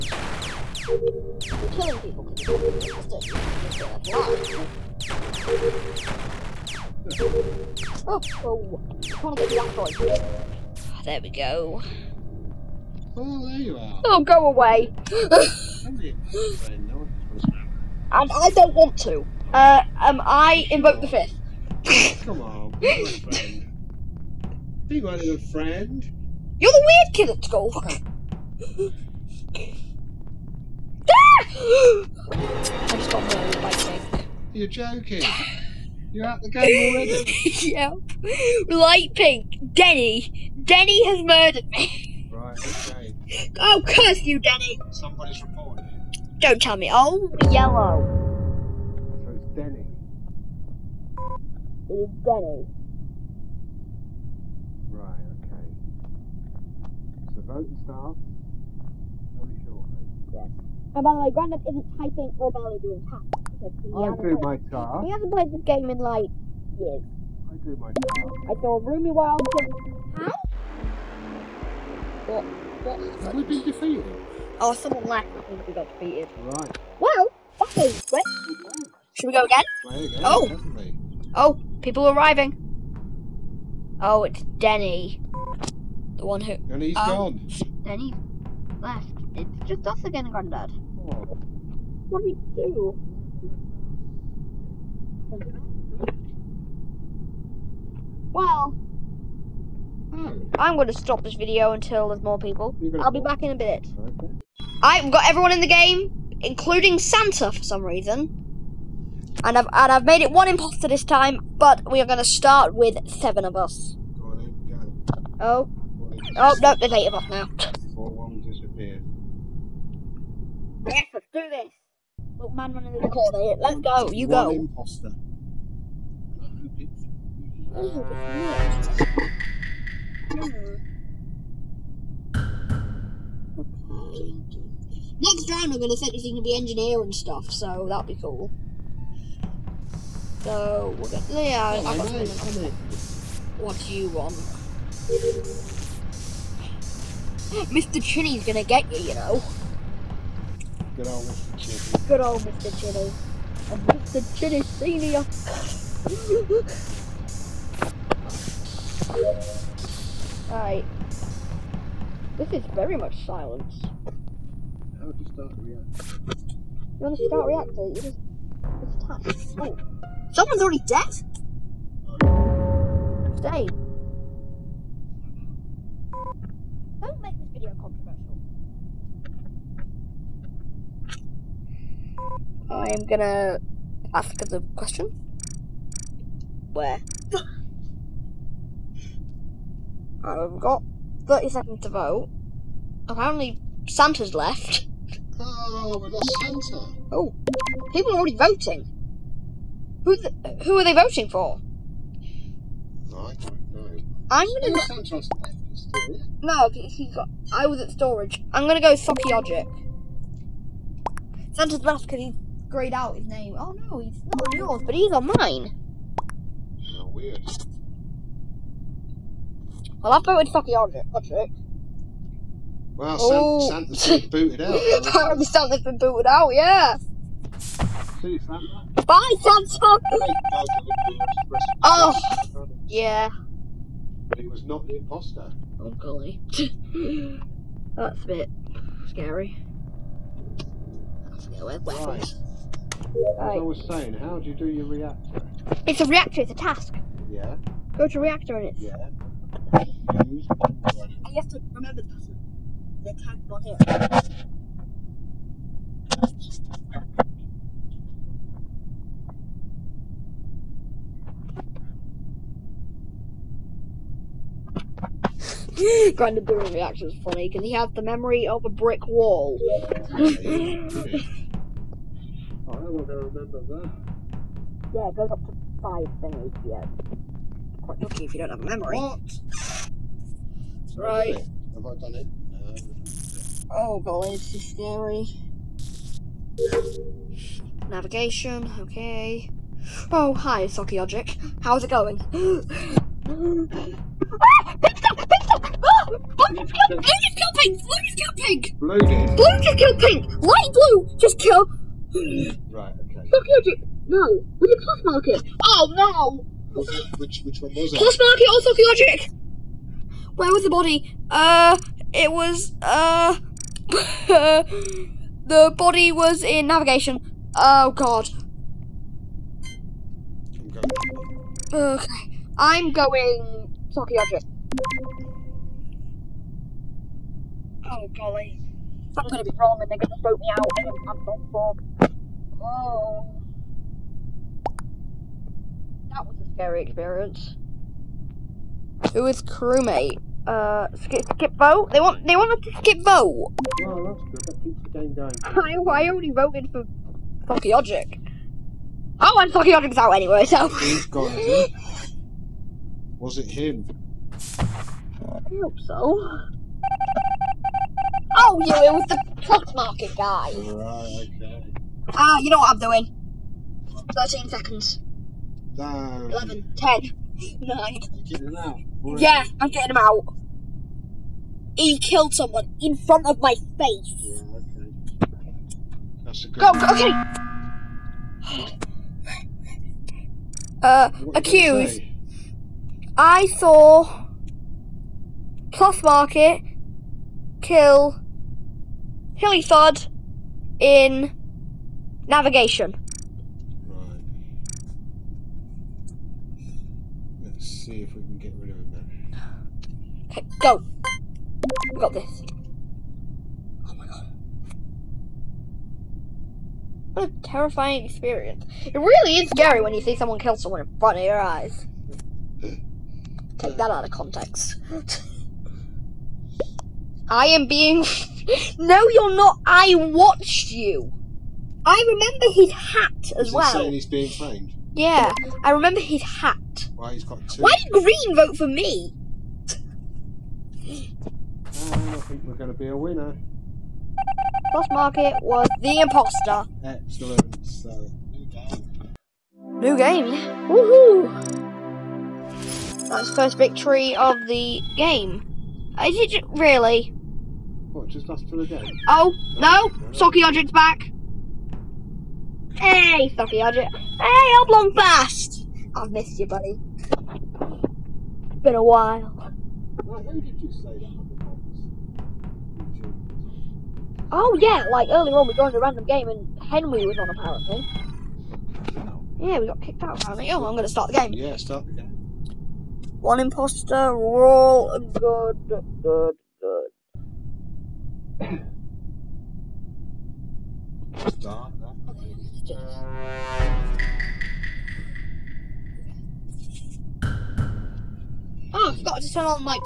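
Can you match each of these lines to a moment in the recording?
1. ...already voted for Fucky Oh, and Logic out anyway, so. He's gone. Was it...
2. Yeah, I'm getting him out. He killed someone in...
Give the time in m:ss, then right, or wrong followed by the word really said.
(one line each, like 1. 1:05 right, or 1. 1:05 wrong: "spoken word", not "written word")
1. 5:46 wrong: "Fucky", not "Logic"
2. 6:09 right.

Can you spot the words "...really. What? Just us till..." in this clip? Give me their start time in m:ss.
7:26.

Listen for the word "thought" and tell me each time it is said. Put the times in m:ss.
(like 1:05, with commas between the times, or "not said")
not said.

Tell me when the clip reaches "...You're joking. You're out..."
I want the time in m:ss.
0:34.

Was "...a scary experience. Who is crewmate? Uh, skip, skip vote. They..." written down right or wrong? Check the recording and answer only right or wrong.
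right.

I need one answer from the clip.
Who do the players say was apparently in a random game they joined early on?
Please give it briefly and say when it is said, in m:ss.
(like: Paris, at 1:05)
Henry, at 7:46.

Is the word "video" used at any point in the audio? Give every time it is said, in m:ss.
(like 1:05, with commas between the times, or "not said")
1:41, 2:57.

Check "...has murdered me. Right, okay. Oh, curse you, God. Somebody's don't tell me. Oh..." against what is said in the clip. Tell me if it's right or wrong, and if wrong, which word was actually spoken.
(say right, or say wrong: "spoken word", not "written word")
wrong: "Denny", not "God".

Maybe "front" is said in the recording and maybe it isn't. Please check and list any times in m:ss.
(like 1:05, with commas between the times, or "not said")
6:12, 6:50.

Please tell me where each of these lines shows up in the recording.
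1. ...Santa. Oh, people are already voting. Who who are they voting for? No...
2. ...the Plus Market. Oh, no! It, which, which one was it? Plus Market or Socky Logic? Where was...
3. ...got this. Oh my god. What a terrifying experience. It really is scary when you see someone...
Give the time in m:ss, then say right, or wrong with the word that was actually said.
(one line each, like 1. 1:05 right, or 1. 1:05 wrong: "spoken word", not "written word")
1. 3:16 right
2. 5:04 right
3. 6:42 right.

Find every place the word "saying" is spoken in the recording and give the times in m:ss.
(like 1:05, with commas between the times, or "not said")
4:03, 7:03.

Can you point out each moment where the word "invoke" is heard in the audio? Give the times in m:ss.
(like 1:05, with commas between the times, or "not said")
0:20.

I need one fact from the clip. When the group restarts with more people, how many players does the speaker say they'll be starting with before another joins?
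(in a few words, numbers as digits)
7.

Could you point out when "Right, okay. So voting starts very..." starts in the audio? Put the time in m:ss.
0:54.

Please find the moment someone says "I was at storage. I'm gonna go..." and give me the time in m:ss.
3:27.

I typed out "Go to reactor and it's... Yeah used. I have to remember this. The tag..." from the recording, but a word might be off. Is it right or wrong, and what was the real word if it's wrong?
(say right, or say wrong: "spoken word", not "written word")
right.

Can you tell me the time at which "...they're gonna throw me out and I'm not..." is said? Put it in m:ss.
5:29.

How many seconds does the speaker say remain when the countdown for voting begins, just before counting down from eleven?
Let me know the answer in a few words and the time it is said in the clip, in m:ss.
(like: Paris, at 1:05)
13, at 6:04.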